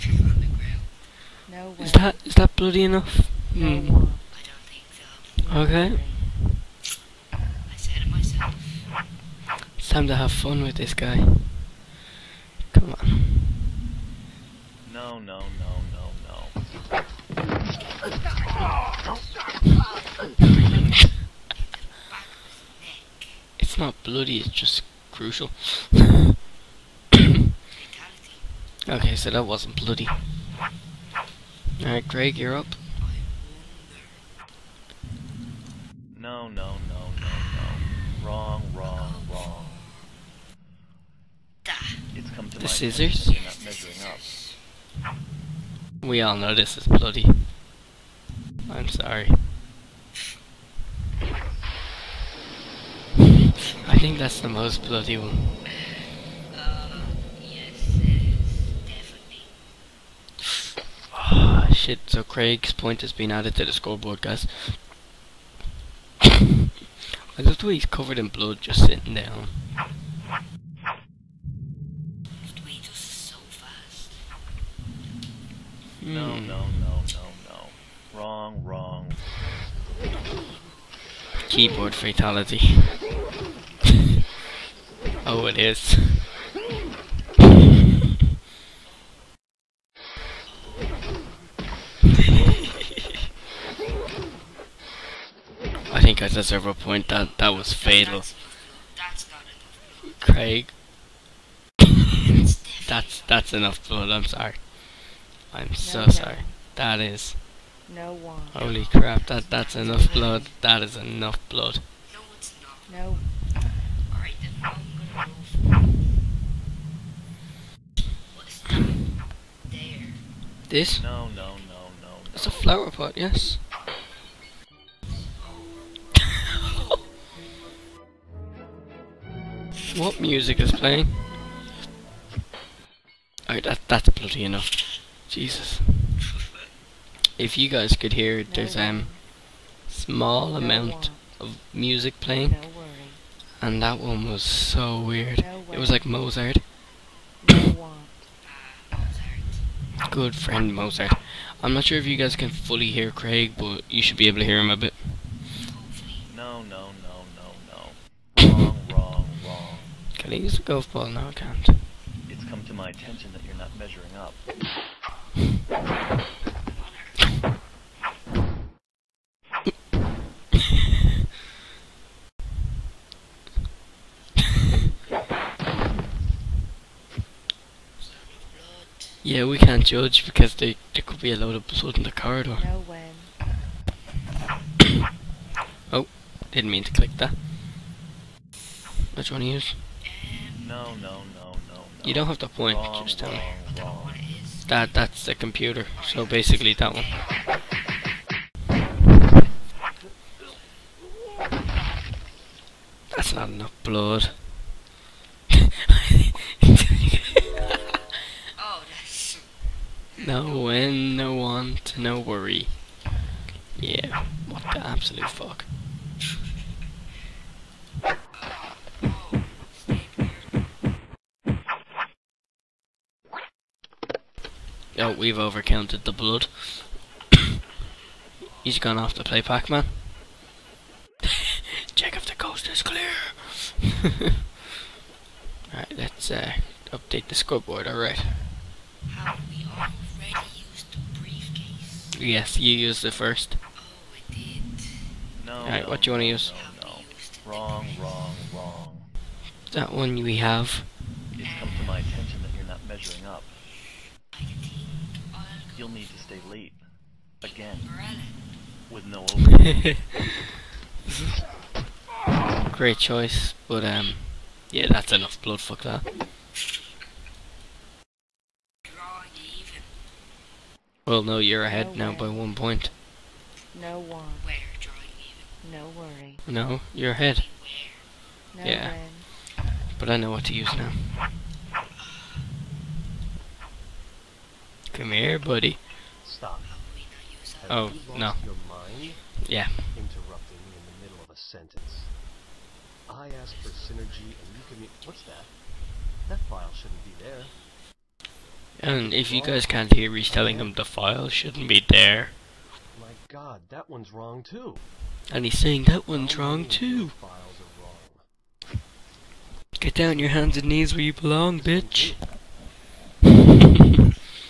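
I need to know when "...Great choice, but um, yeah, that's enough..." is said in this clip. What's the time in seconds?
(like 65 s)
262 s.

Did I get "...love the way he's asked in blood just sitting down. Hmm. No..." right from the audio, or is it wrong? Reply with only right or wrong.
wrong.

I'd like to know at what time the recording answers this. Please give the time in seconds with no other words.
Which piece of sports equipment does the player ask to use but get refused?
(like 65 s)
160 s.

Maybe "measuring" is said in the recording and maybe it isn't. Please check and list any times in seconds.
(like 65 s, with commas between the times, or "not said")
163 s, 252 s.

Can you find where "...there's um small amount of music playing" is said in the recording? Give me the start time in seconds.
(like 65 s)
138 s.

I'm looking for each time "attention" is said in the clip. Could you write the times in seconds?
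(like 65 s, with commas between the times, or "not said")
162 s, 251 s.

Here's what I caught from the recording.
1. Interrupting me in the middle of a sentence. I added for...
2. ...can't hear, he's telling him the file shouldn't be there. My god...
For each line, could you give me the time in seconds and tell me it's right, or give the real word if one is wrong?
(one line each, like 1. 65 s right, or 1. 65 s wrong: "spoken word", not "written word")
1. 289 s wrong: "asked", not "added"
2. 299 s right.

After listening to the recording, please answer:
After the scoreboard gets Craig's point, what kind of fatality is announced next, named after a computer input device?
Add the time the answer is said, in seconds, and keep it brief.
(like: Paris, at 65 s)
Keyboard fatality, at 81 s.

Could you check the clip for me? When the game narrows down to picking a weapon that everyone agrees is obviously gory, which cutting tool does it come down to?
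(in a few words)
Scissors.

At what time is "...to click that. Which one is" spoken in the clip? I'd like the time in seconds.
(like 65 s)
186 s.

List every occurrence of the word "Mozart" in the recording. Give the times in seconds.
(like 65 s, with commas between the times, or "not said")
146 s, 150 s.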